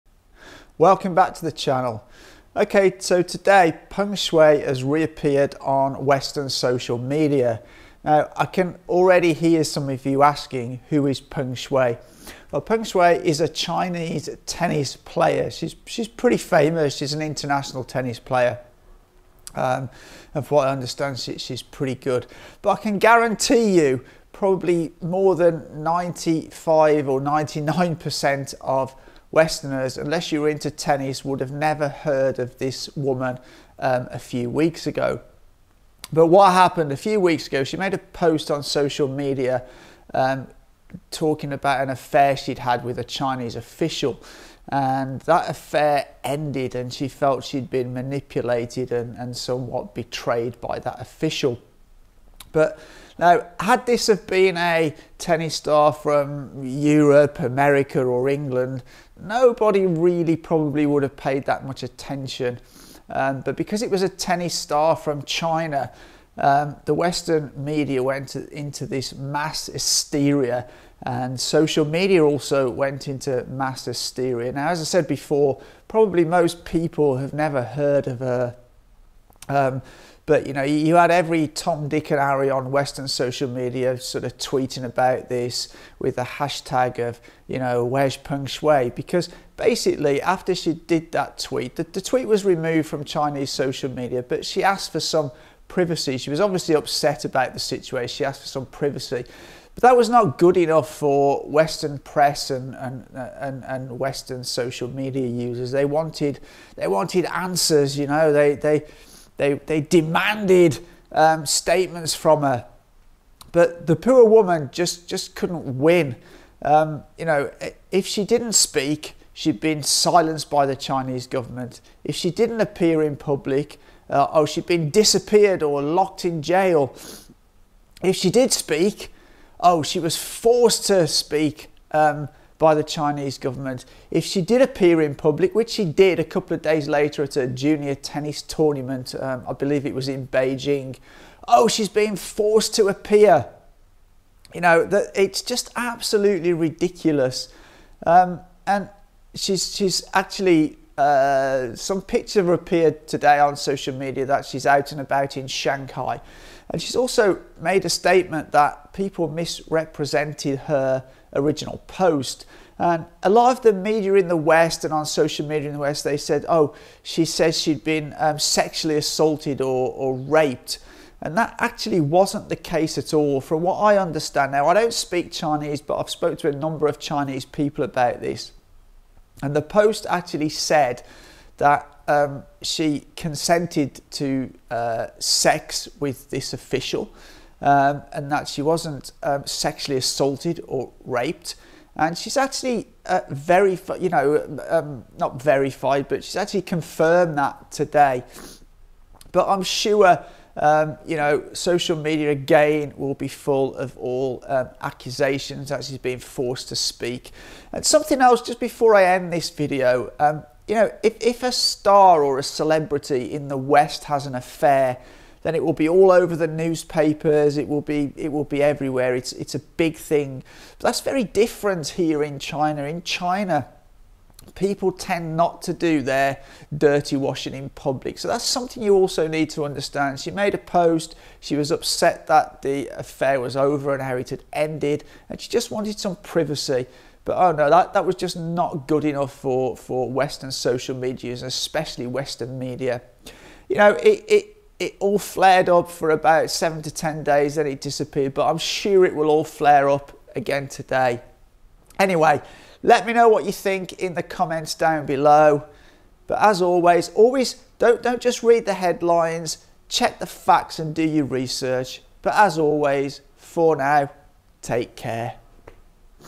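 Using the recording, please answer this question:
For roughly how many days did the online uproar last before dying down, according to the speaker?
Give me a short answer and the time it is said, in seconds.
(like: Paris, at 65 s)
7 to 10 days, at 246 s.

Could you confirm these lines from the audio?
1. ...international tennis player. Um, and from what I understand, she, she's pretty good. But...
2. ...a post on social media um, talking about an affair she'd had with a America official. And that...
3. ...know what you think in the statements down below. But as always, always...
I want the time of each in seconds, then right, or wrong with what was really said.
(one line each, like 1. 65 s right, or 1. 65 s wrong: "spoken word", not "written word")
1. 17 s right
2. 37 s wrong: "Chinese", not "America"
3. 253 s wrong: "comments", not "statements".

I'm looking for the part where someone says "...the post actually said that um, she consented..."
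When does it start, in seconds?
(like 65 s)
179 s.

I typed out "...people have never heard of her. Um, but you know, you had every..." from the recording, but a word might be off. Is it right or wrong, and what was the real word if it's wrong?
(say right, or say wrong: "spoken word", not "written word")
right.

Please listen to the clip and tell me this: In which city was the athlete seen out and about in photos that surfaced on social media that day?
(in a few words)
Shanghai.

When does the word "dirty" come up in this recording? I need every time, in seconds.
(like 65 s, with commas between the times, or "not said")
226 s.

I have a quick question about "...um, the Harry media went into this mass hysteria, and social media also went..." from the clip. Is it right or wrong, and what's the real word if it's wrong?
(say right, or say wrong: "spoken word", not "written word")
wrong: "Western", not "Harry".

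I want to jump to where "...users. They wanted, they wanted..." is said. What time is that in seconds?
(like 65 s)
105 s.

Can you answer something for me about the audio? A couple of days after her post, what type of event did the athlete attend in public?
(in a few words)
junior tennis tournament.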